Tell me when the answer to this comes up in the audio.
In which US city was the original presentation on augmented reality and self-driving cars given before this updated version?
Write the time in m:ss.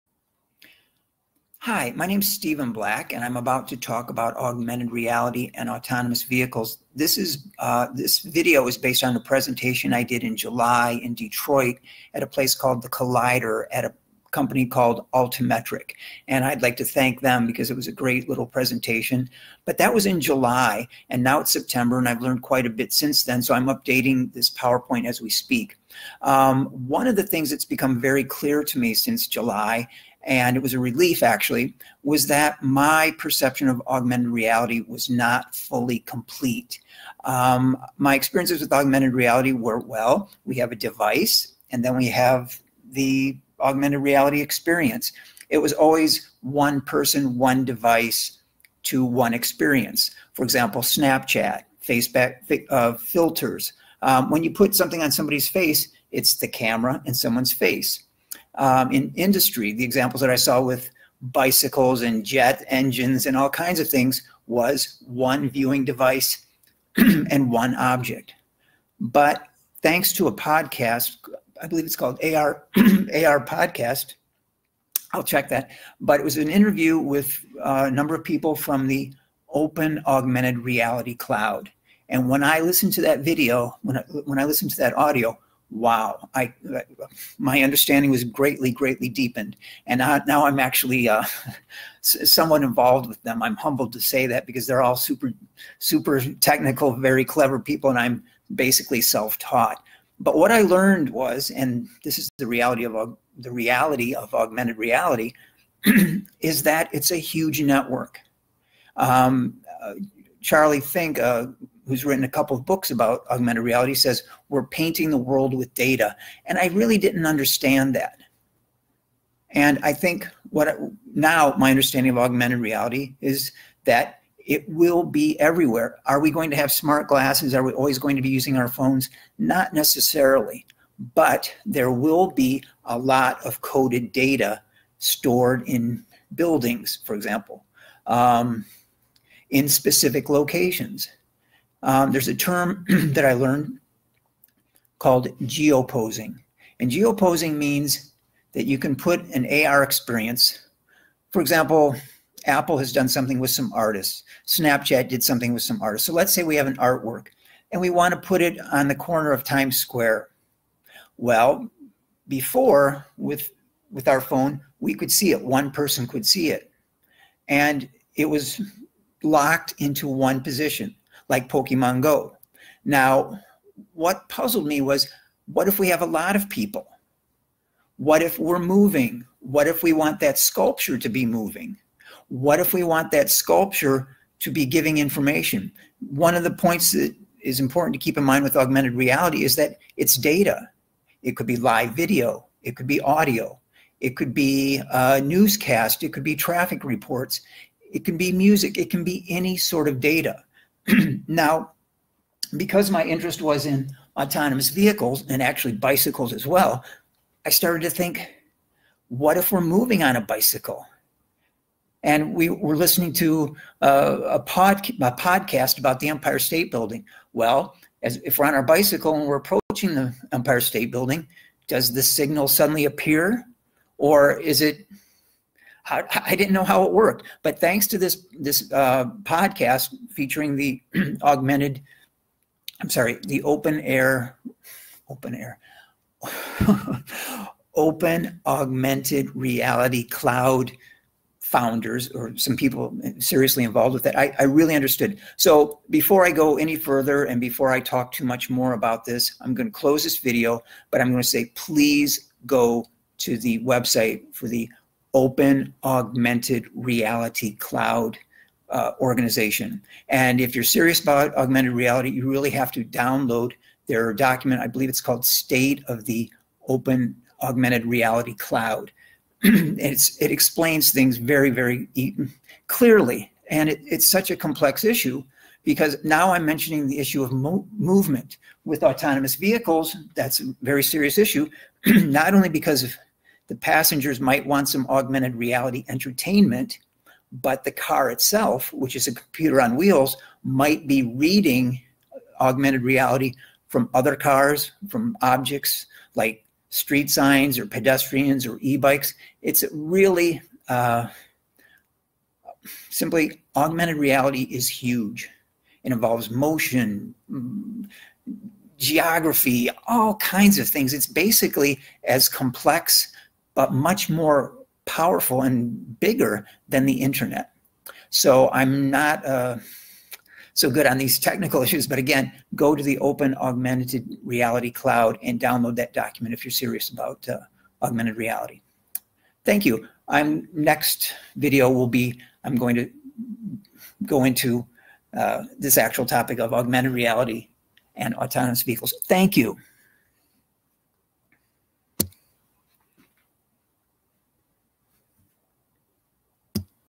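0:11.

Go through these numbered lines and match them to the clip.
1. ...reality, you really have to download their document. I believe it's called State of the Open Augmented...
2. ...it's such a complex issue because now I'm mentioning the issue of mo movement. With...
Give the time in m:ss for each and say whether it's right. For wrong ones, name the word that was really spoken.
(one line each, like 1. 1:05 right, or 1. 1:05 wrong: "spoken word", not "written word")
1. 4:21 right
2. 4:33 right.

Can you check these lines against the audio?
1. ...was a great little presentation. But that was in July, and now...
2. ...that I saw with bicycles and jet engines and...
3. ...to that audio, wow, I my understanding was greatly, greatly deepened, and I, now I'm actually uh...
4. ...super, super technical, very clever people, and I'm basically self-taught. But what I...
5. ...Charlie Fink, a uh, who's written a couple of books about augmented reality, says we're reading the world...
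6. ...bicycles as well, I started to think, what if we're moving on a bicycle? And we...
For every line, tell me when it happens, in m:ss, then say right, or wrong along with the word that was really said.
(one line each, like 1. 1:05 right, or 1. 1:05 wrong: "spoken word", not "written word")
1. 0:17 right
2. 1:00 right
3. 1:24 right
4. 1:34 right
5. 1:50 wrong: "painting", not "reading"
6. 3:25 right.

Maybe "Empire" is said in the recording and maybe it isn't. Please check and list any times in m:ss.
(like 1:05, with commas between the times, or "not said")
3:36, 3:40.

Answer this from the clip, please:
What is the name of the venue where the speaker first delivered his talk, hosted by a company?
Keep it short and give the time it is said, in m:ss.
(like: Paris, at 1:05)
the Collider, at 0:12.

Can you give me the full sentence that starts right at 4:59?
It's really uh, simply augmented reality is huge.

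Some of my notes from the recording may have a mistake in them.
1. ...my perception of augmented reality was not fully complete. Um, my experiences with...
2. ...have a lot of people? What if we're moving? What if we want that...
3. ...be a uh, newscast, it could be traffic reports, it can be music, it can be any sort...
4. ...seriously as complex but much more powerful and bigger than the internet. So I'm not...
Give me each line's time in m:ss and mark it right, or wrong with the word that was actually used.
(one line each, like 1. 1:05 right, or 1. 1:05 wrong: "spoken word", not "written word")
1. 0:32 right
2. 2:55 right
3. 3:14 right
4. 5:11 wrong: "basically", not "seriously".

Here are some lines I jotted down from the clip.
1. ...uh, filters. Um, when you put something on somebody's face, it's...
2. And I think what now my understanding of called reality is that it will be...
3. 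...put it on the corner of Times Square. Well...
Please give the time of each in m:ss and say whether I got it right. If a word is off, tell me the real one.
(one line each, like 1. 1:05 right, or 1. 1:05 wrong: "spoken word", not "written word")
1. 0:52 right
2. 1:59 wrong: "augmented", not "called"
3. 2:38 right.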